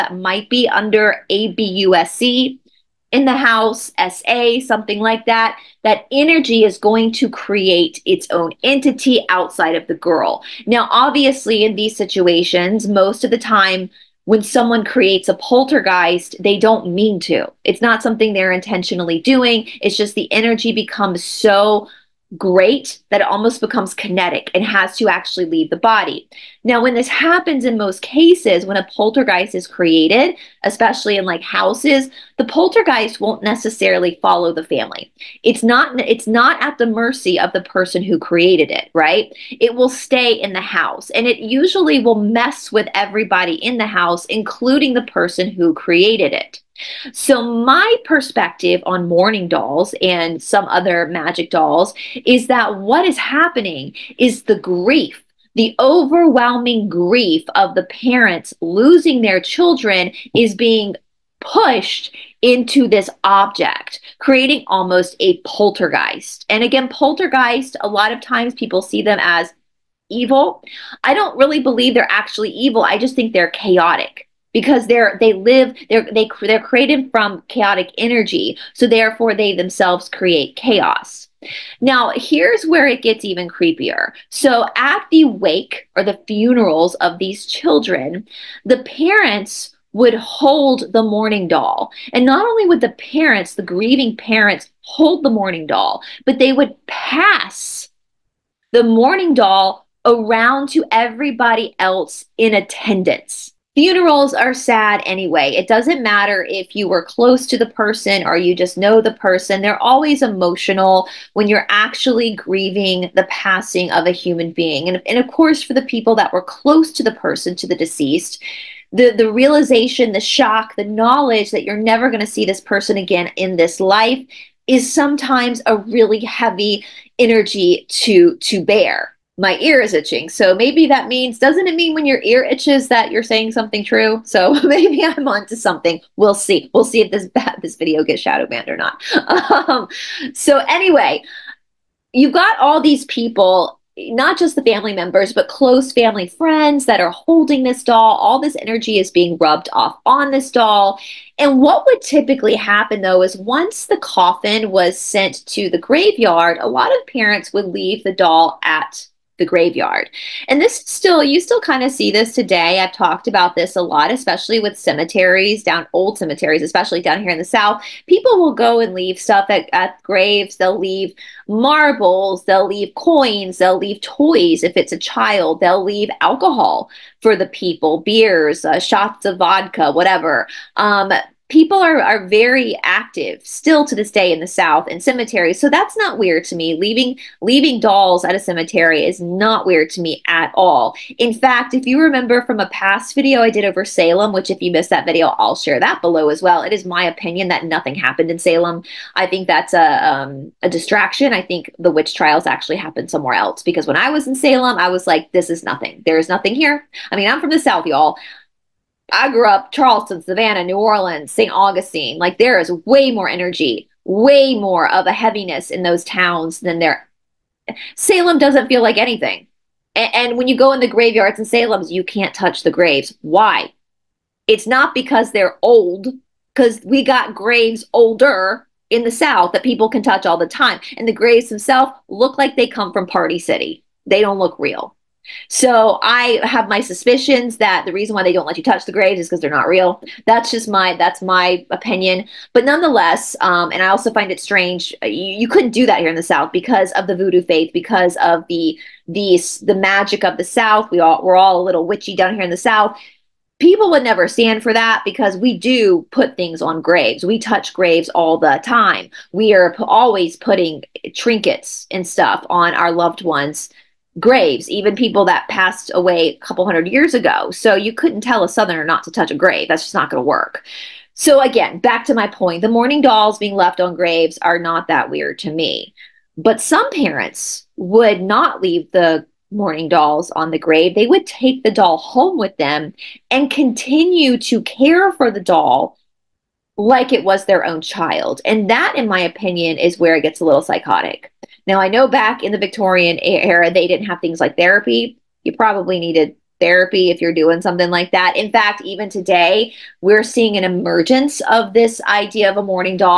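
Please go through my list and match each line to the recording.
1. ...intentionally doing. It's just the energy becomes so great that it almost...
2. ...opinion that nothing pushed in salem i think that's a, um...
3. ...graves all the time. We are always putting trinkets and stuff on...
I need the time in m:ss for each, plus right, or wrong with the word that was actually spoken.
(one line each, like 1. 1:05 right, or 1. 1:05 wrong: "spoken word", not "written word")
1. 0:18 right
2. 3:17 wrong: "happened", not "pushed"
3. 4:17 right.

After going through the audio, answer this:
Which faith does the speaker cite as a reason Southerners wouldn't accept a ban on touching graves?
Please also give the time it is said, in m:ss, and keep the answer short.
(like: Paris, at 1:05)
Voodoo, at 4:07.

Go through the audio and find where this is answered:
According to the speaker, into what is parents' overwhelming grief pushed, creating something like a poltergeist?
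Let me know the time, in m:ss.
1:01.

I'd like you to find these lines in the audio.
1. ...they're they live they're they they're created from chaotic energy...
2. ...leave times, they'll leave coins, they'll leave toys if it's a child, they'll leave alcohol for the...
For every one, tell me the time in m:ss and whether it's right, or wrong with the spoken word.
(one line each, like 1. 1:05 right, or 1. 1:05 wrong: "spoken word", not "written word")
1. 1:14 right
2. 2:50 wrong: "marbles", not "times".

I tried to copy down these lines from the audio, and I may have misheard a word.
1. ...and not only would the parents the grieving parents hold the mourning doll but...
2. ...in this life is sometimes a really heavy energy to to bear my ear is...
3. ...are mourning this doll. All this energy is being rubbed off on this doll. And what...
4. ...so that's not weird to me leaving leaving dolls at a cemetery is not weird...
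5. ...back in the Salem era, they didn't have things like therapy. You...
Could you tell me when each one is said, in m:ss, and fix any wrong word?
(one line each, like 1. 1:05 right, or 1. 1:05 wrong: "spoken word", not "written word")
1. 1:32 right
2. 2:03 right
3. 2:26 wrong: "holding", not "mourning"
4. 3:05 right
5. 4:52 wrong: "Victorian", not "Salem".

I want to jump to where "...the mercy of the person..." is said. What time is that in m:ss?
0:36.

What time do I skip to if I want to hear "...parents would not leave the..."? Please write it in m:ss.
4:36.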